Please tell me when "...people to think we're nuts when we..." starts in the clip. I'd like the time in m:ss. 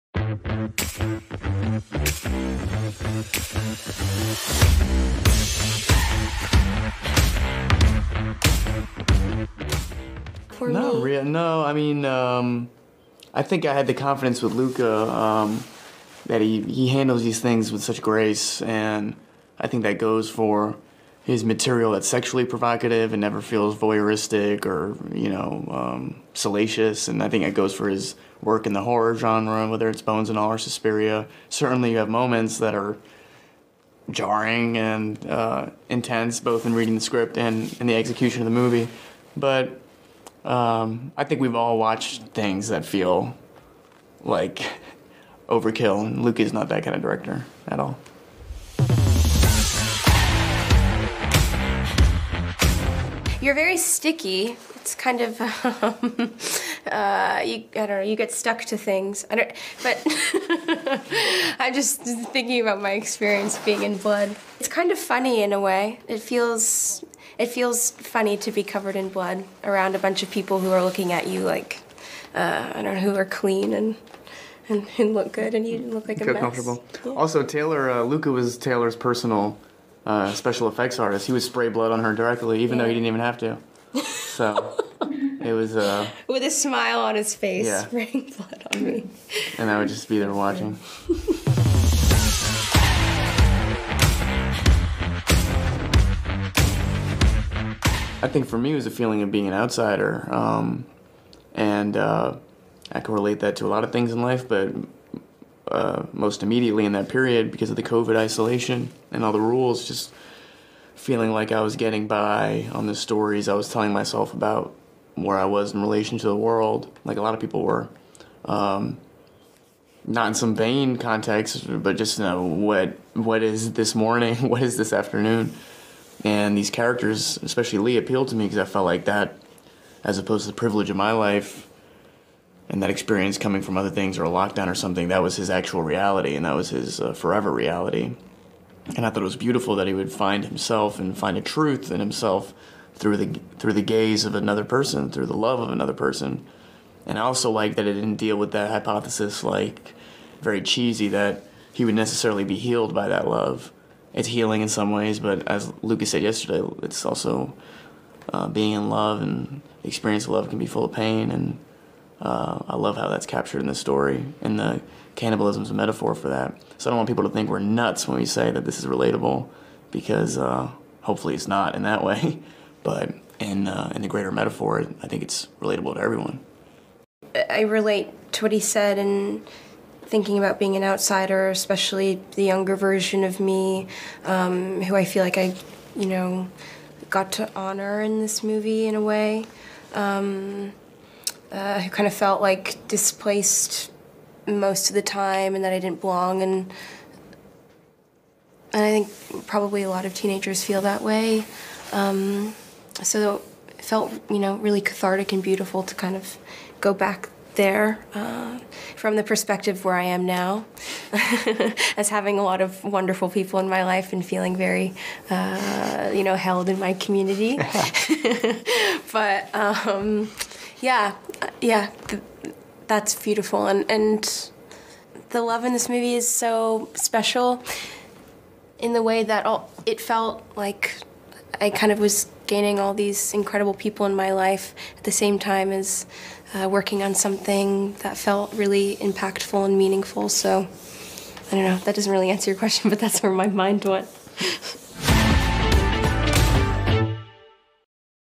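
2:47.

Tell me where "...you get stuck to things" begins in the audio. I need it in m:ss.
0:58.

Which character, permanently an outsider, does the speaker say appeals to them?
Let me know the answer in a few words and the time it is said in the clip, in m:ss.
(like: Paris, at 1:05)
Lee, at 2:07.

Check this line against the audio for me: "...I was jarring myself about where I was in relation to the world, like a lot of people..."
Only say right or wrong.
wrong.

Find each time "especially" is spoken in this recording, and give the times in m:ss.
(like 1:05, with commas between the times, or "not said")
2:07, 3:01.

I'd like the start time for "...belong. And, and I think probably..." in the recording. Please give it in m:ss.
3:16.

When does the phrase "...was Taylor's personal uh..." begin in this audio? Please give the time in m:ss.
1:18.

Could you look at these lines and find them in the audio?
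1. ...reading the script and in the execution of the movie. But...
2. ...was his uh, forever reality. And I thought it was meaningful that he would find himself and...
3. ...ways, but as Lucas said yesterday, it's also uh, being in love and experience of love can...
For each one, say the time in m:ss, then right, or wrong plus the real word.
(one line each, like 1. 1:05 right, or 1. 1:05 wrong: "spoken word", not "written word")
1. 0:36 right
2. 2:16 wrong: "beautiful", not "meaningful"
3. 2:34 right.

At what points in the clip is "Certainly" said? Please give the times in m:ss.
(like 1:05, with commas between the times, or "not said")
0:31.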